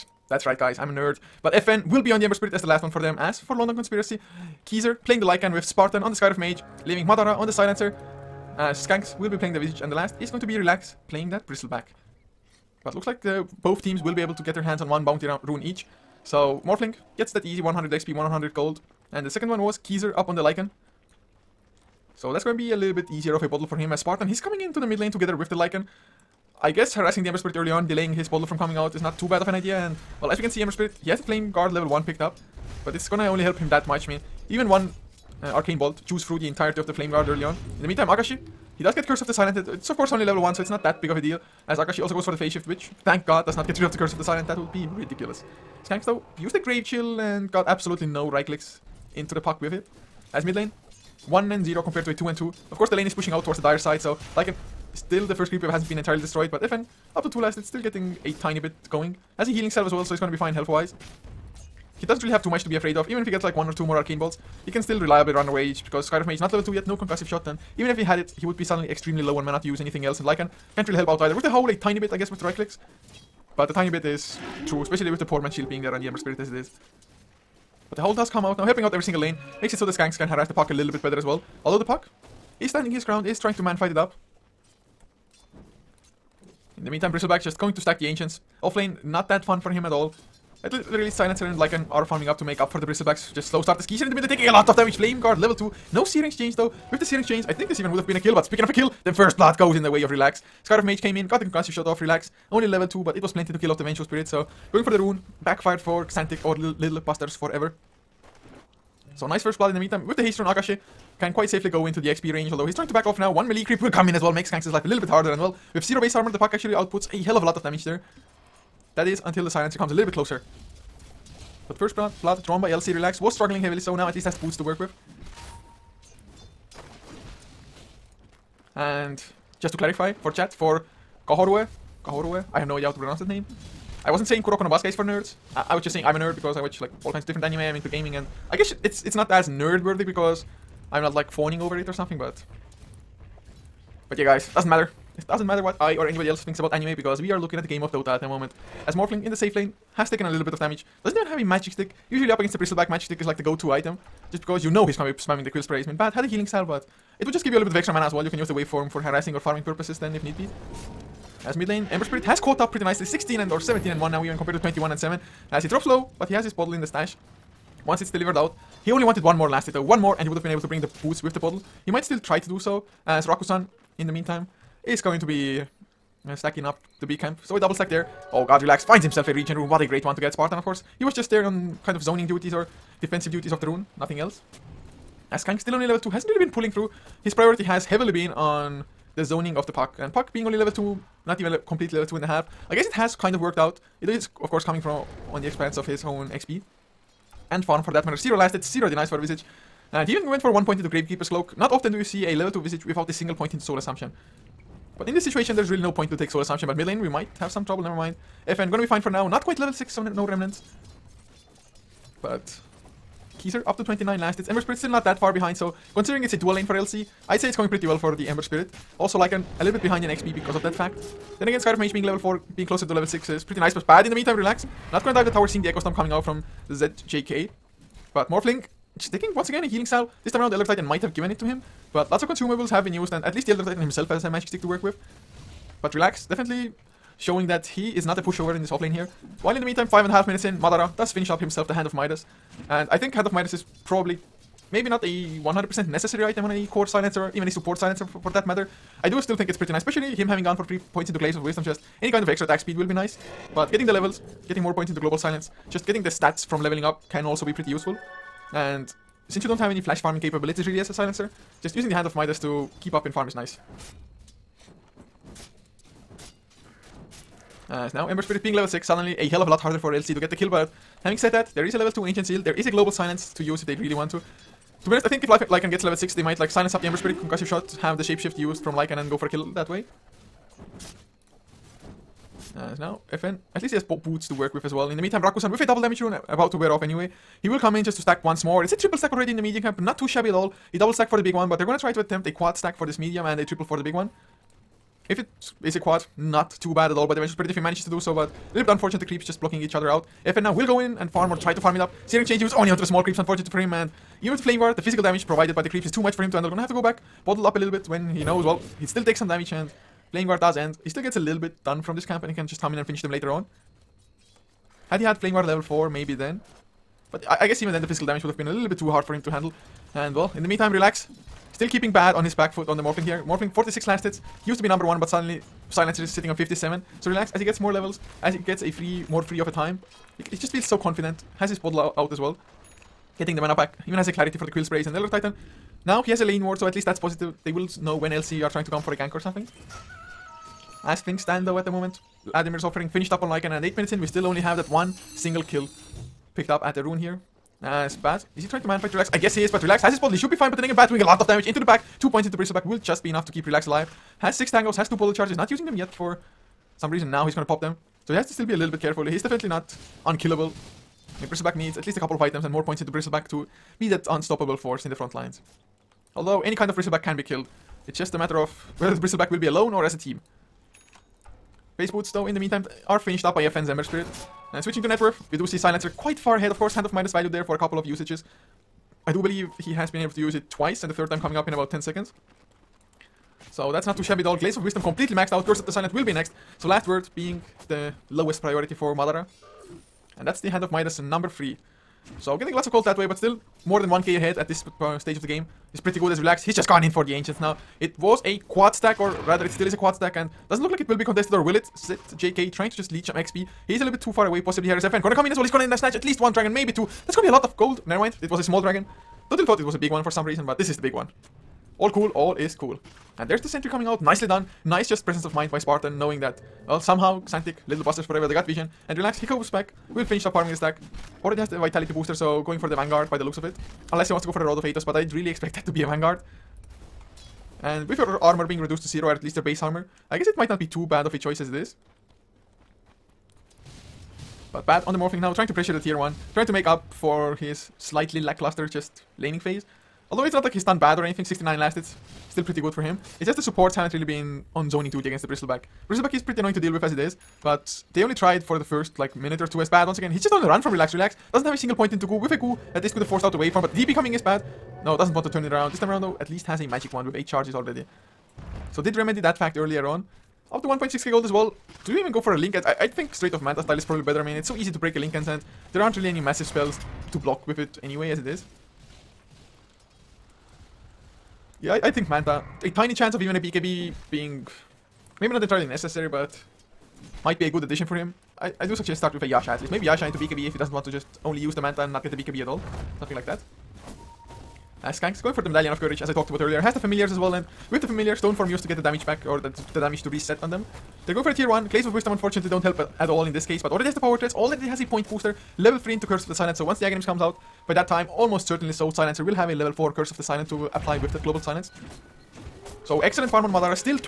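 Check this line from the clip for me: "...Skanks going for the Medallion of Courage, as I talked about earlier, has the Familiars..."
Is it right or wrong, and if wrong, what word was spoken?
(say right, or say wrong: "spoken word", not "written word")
right.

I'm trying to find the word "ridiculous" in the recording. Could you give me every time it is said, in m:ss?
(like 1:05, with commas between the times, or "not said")
0:44.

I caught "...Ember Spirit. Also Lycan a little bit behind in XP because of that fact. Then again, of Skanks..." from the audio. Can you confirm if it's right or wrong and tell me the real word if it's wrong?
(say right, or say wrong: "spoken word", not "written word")
wrong: "Mage", not "Skanks".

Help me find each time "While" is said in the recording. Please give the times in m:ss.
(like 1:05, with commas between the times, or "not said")
3:59.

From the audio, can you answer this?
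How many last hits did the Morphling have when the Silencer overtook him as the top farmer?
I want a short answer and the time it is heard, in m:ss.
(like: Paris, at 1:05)
46, at 5:23.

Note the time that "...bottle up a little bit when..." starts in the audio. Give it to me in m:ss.
5:07.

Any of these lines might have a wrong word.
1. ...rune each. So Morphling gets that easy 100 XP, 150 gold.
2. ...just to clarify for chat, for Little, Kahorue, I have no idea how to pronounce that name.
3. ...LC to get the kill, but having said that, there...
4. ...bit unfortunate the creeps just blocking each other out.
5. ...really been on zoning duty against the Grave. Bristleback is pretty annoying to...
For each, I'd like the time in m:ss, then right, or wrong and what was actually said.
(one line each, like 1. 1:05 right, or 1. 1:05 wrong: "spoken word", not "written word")
1. 0:15 wrong: "100", not "150"
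2. 2:09 wrong: "Kahorue", not "Little"
3. 4:29 right
4. 4:58 right
5. 7:23 wrong: "Bristleback", not "Grave".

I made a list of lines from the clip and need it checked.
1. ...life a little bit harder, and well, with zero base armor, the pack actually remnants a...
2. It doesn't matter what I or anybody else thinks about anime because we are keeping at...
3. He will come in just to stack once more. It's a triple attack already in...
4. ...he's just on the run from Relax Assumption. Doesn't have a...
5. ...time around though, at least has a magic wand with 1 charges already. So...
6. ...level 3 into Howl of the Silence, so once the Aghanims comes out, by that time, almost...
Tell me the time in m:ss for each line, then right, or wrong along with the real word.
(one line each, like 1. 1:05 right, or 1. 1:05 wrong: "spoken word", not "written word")
1. 1:54 wrong: "outputs", not "remnants"
2. 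2:25 wrong: "looking", not "keeping"
3. 4:47 wrong: "stack", not "attack"
4. 7:30 wrong: "Relax", not "Assumption"
5. 7:35 wrong: "8", not "1"
6. 8:15 wrong: "Curse", not "Howl".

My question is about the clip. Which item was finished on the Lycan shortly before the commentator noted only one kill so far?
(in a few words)
Vladimir's Offering.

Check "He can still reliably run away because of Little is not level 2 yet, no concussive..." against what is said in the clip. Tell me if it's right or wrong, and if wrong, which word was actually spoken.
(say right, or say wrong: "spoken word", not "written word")
wrong: "Mage", not "Little".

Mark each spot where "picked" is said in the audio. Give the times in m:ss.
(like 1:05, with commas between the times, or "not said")
0:32, 5:46.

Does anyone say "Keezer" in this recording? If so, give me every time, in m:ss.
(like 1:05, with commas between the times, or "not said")
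0:04, 0:19, 1:33, 3:33.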